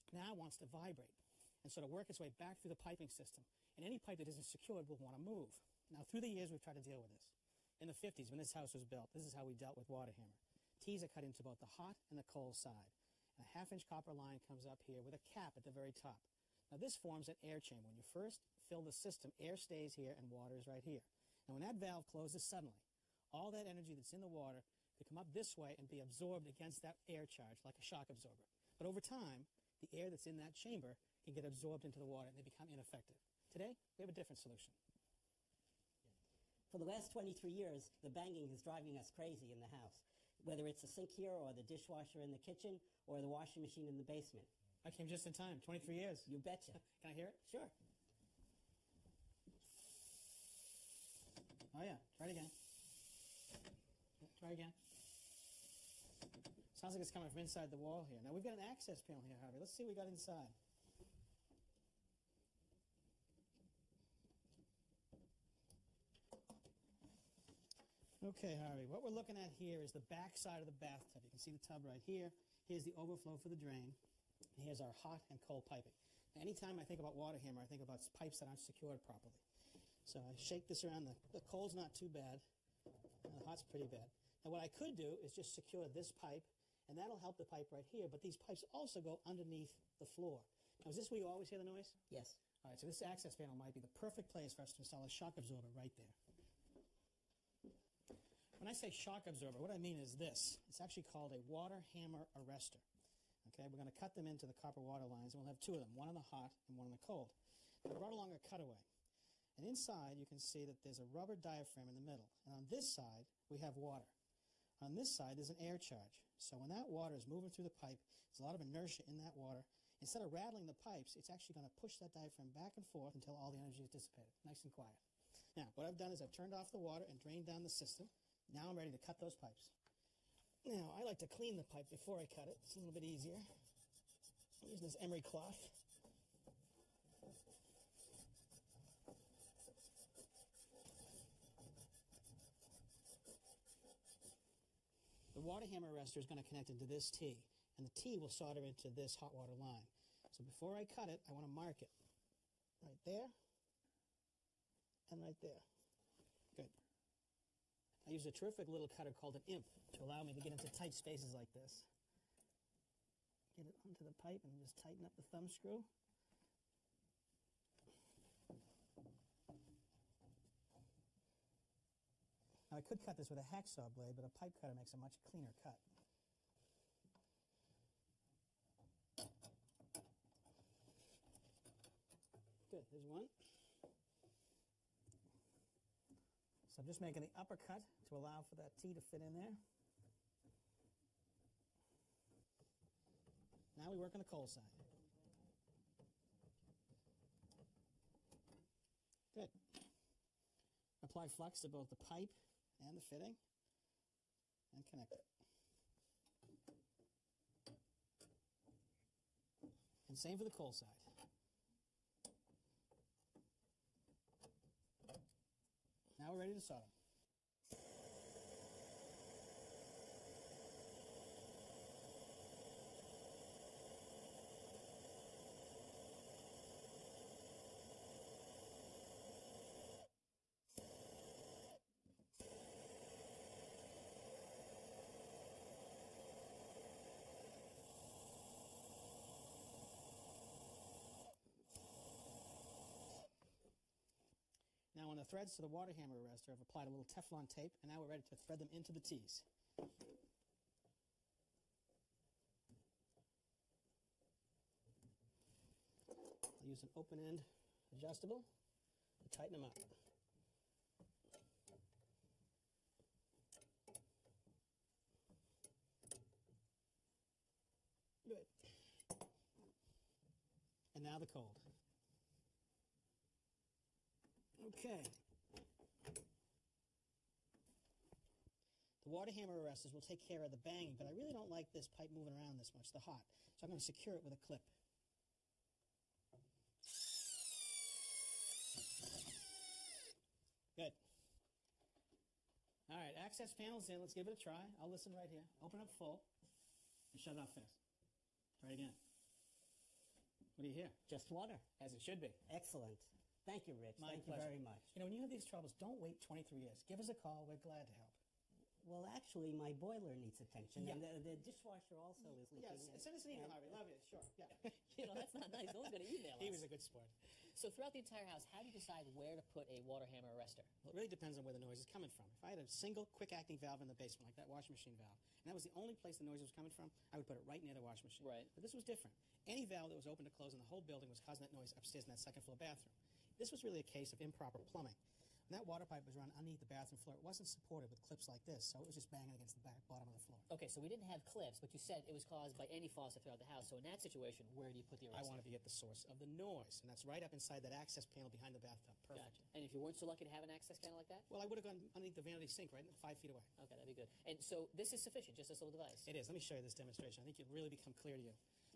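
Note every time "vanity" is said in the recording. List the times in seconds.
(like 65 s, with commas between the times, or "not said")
352 s.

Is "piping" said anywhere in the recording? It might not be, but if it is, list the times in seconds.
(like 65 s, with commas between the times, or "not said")
2 s, 75 s.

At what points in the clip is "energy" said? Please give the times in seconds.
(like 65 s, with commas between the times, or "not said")
23 s, 123 s.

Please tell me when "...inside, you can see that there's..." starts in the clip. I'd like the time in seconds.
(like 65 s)
109 s.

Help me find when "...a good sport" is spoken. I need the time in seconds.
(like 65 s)
316 s.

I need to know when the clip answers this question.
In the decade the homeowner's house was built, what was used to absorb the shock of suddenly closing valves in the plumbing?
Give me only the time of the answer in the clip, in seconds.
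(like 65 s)
17 s.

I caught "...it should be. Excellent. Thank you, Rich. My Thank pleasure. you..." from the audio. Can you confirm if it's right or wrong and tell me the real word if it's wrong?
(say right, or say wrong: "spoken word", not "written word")
right.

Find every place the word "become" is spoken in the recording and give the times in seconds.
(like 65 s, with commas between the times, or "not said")
32 s, 357 s.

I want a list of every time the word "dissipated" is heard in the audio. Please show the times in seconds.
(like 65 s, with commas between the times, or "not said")
123 s.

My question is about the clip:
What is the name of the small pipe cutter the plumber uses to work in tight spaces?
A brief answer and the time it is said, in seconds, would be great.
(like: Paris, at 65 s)
imp, at 159 s.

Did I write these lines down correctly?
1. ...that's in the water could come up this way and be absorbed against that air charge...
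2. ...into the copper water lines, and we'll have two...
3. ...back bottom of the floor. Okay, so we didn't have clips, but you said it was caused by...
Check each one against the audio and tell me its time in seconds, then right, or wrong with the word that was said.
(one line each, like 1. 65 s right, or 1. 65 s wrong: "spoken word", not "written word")
1. 23 s right
2. 104 s right
3. 339 s right.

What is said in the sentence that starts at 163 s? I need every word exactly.
Get it onto the pipe and just tighten up the thumb screw.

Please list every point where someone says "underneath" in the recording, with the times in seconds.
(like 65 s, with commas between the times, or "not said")
89 s, 336 s, 351 s.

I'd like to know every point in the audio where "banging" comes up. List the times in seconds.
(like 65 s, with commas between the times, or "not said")
38 s, 280 s, 339 s.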